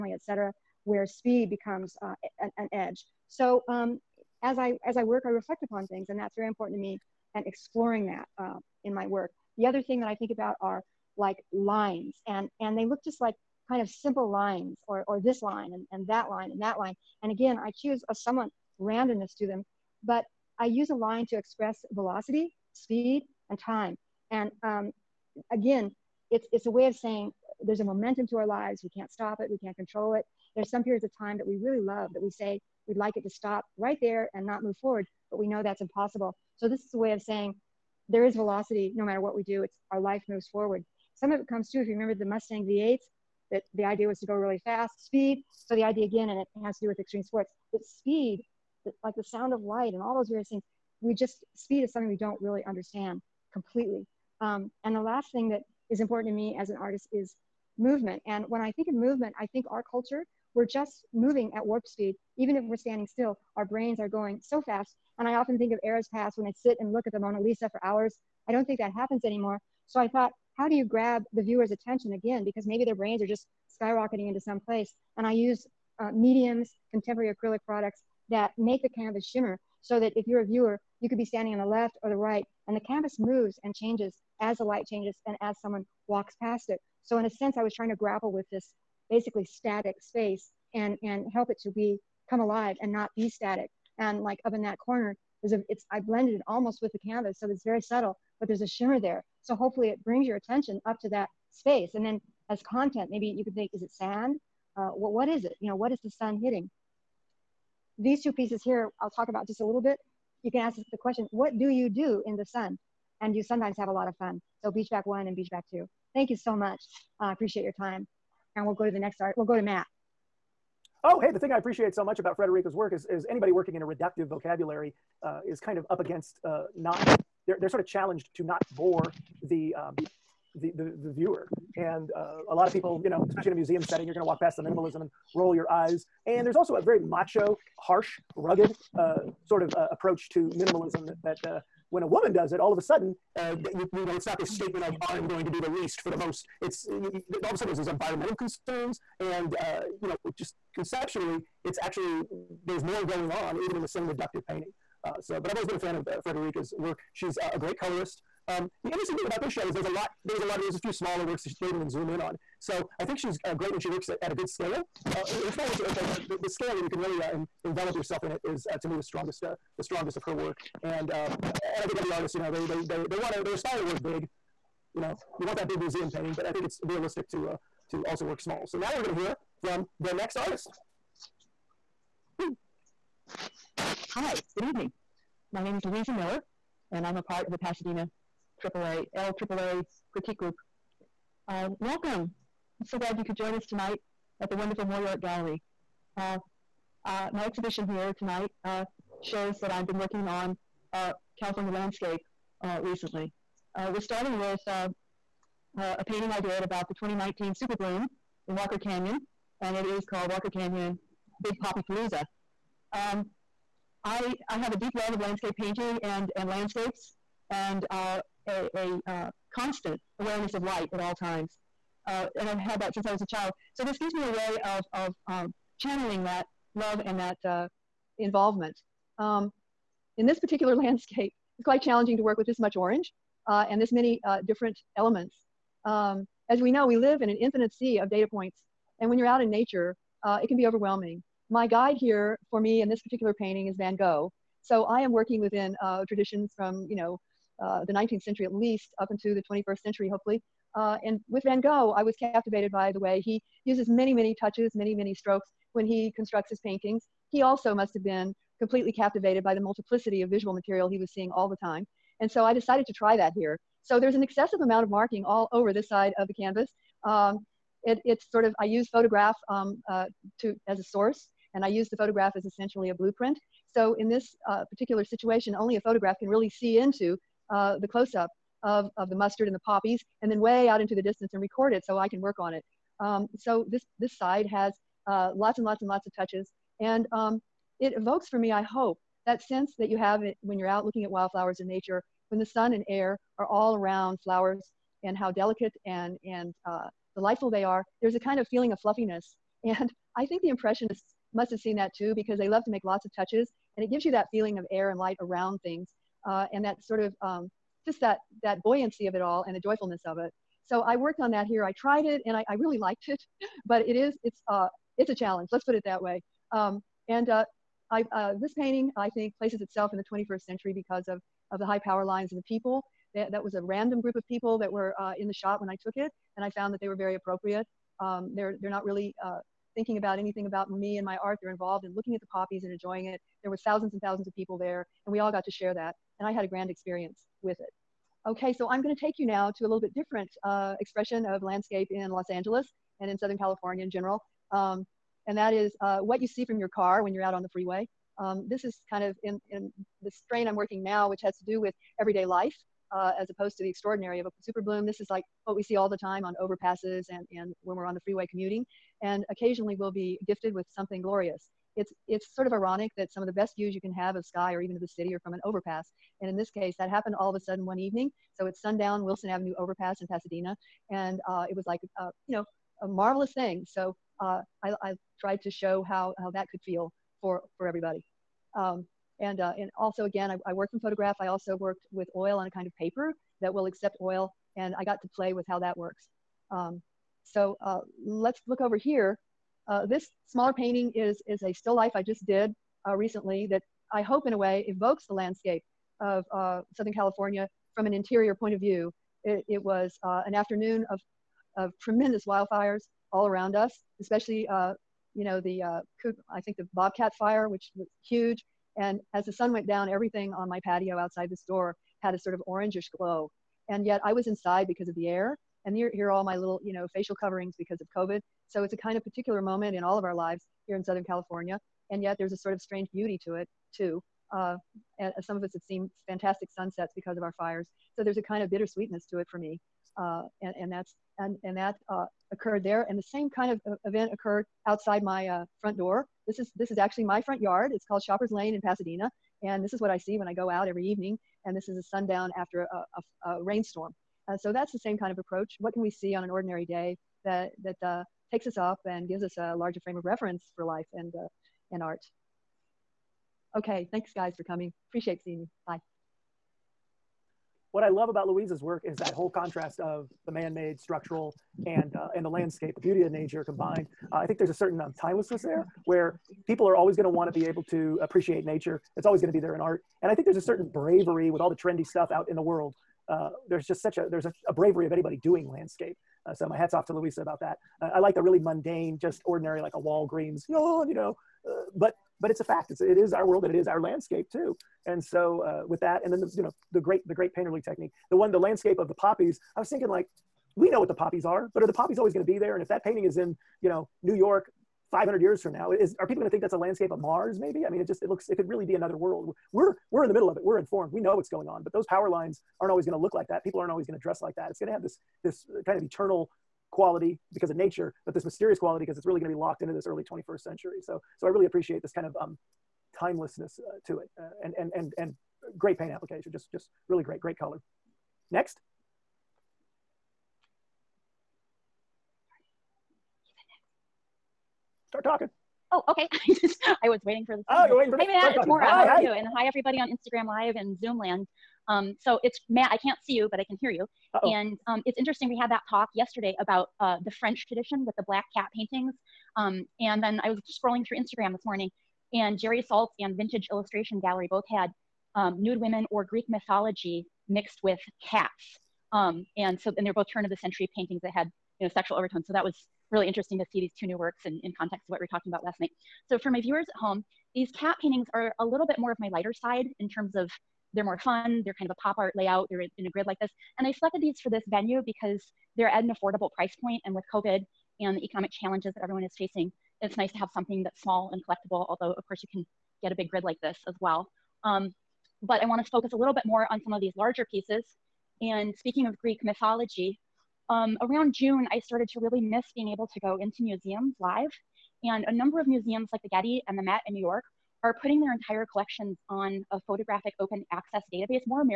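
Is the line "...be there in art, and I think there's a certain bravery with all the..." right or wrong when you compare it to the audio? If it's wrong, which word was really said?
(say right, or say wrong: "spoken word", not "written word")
right.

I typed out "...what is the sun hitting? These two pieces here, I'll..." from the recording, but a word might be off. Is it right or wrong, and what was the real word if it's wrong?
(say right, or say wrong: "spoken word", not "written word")
right.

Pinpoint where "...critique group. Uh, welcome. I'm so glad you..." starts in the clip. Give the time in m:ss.
3:10.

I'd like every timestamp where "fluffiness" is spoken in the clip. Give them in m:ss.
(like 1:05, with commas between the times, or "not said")
4:58.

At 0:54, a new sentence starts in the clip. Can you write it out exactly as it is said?
Um, and the last thing that is important to me as an artist is movement.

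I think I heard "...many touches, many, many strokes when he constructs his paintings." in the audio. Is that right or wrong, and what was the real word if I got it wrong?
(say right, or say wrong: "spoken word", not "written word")
right.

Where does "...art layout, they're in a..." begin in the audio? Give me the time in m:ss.
9:21.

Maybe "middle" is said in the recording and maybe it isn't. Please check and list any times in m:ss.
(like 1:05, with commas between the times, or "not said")
8:20.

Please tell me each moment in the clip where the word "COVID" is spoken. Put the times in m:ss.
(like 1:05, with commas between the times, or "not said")
6:57, 9:27.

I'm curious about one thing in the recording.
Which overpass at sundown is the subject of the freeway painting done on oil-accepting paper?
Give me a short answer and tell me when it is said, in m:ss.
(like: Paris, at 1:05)
Wilson Avenue, at 6:09.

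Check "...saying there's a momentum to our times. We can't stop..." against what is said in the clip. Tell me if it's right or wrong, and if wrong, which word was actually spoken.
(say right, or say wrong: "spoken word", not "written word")
wrong: "lives", not "times".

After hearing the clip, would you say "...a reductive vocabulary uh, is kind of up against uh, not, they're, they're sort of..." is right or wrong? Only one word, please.
right.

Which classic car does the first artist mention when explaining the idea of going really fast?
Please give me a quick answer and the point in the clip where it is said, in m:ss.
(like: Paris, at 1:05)
Mustang V8, at 0:42.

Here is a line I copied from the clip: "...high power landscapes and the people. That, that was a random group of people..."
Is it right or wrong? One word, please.
wrong.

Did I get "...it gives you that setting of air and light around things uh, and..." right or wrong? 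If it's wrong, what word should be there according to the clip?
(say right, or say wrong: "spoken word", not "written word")
wrong: "feeling", not "setting".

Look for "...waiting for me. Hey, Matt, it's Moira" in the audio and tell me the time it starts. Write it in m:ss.
8:47.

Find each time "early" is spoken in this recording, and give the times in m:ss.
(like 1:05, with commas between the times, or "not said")
8:29.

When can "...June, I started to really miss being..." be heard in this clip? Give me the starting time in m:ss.
9:41.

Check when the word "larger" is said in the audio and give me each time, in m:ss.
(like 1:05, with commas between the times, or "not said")
7:29, 9:36.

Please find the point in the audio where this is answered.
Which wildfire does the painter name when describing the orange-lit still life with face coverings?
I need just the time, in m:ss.
6:46.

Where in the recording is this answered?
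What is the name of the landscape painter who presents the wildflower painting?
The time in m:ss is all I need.
3:05.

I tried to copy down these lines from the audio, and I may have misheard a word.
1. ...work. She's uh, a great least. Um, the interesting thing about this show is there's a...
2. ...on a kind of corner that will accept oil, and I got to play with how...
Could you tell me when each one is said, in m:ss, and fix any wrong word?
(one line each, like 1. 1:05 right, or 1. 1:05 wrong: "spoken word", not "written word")
1. 2:36 wrong: "colorist", not "least"
2. 6:22 wrong: "paper", not "corner".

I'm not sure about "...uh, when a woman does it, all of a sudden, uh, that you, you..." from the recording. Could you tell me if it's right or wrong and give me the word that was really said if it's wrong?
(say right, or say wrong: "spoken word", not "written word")
right.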